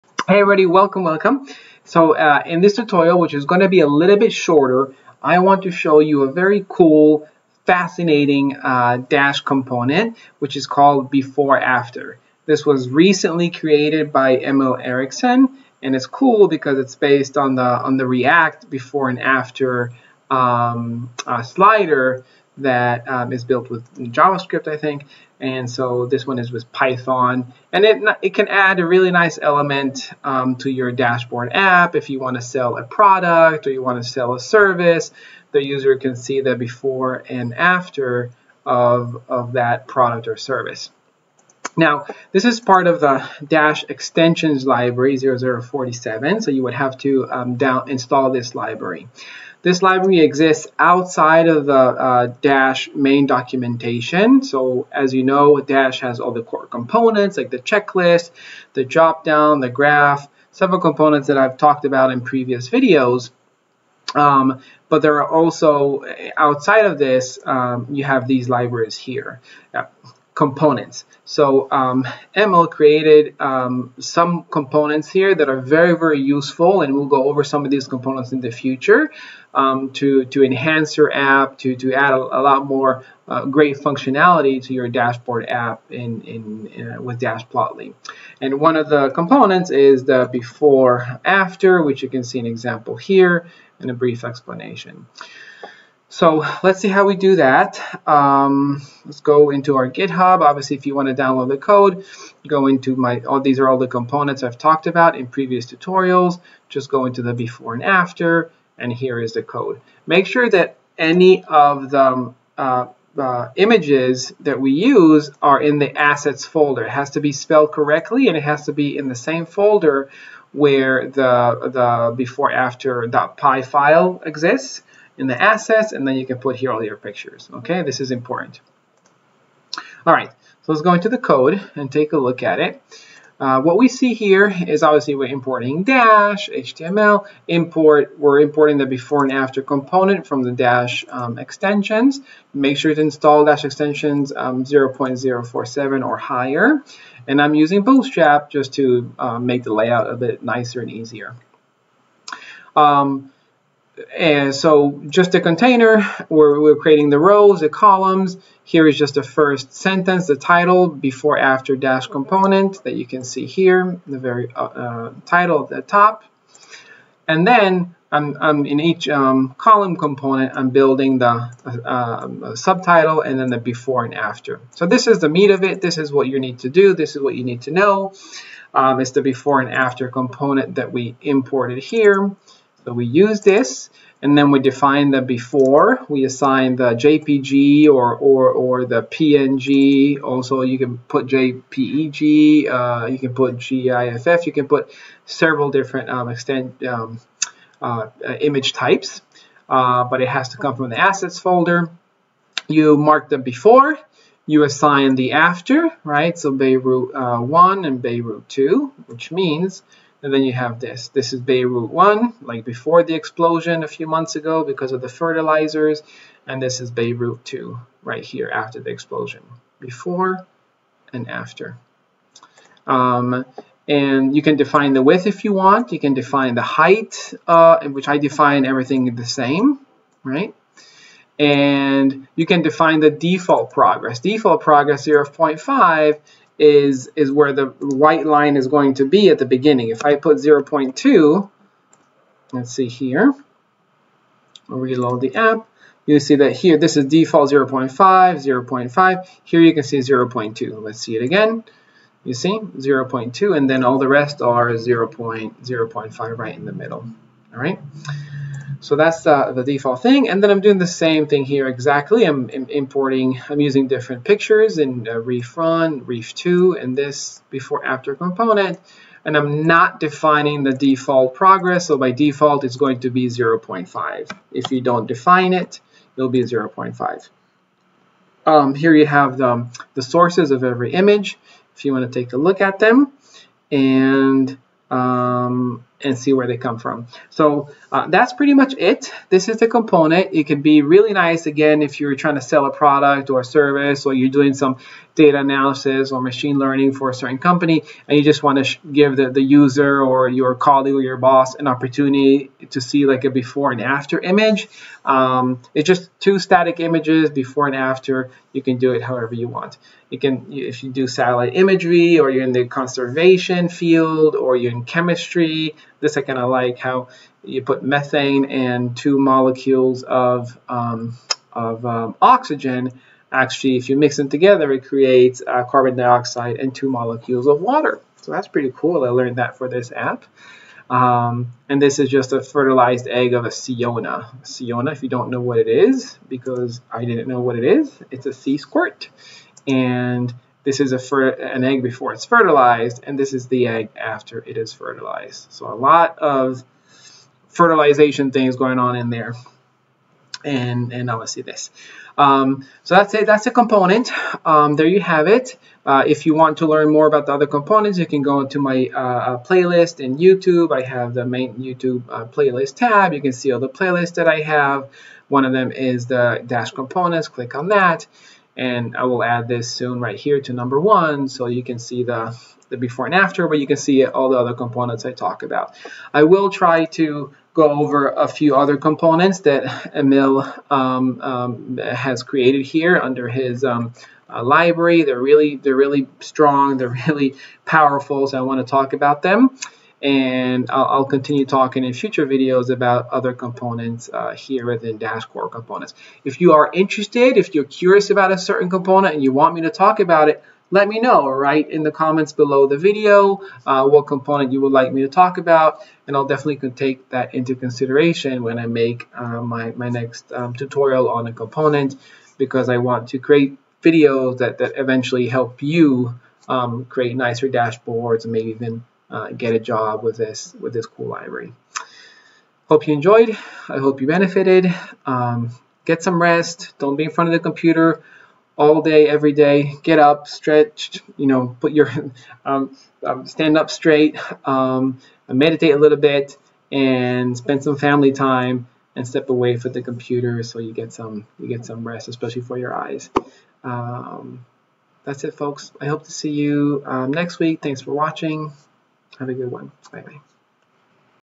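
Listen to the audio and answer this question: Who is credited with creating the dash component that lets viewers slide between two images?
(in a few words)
Emil Eriksson.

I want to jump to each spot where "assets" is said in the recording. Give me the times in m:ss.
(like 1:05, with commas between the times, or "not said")
1:55, 2:05, 3:20.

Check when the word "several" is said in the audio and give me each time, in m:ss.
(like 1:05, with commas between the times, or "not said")
1:00, 3:15.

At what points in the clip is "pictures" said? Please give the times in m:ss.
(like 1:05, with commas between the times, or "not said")
2:06, 4:24.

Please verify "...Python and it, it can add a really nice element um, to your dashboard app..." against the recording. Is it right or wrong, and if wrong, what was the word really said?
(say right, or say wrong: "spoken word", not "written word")
right.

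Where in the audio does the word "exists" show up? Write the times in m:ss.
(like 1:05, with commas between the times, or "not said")
0:50, 2:04.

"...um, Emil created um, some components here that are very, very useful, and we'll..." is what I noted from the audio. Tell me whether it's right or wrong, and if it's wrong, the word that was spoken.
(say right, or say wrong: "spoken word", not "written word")
right.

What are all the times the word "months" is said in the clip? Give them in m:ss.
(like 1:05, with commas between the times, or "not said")
3:34.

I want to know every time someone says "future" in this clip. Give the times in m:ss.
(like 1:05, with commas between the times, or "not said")
1:18, 6:31.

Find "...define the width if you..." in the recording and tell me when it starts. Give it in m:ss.
3:44.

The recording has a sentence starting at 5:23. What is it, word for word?
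Actually, if you mix them together, it creates uh, carbon dioxide and two molecules of water.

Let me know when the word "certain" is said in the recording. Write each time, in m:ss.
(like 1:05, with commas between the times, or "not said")
4:57, 6:38.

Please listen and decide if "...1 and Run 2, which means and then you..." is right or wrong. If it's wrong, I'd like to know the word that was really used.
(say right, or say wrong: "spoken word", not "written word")
wrong: "Beirut", not "Run".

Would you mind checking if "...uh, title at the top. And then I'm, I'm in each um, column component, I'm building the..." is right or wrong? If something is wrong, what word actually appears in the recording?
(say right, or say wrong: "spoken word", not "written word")
right.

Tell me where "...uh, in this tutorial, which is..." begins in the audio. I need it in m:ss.
0:02.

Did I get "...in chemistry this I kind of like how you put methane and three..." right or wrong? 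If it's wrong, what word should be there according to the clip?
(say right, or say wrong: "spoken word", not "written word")
wrong: "two", not "three".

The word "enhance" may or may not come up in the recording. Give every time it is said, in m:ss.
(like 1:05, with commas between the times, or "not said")
1:20.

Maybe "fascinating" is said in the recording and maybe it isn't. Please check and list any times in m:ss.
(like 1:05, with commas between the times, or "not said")
0:07.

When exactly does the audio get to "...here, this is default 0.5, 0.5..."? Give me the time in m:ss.
4:06.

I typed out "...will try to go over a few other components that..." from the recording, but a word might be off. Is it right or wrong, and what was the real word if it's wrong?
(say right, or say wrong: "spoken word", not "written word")
right.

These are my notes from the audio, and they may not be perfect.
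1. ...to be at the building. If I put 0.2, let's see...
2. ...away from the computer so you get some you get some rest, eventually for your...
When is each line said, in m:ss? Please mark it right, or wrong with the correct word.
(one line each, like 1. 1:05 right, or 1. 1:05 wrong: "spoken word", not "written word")
1. 3:58 wrong: "beginning", not "building"
2. 7:19 wrong: "especially", not "eventually".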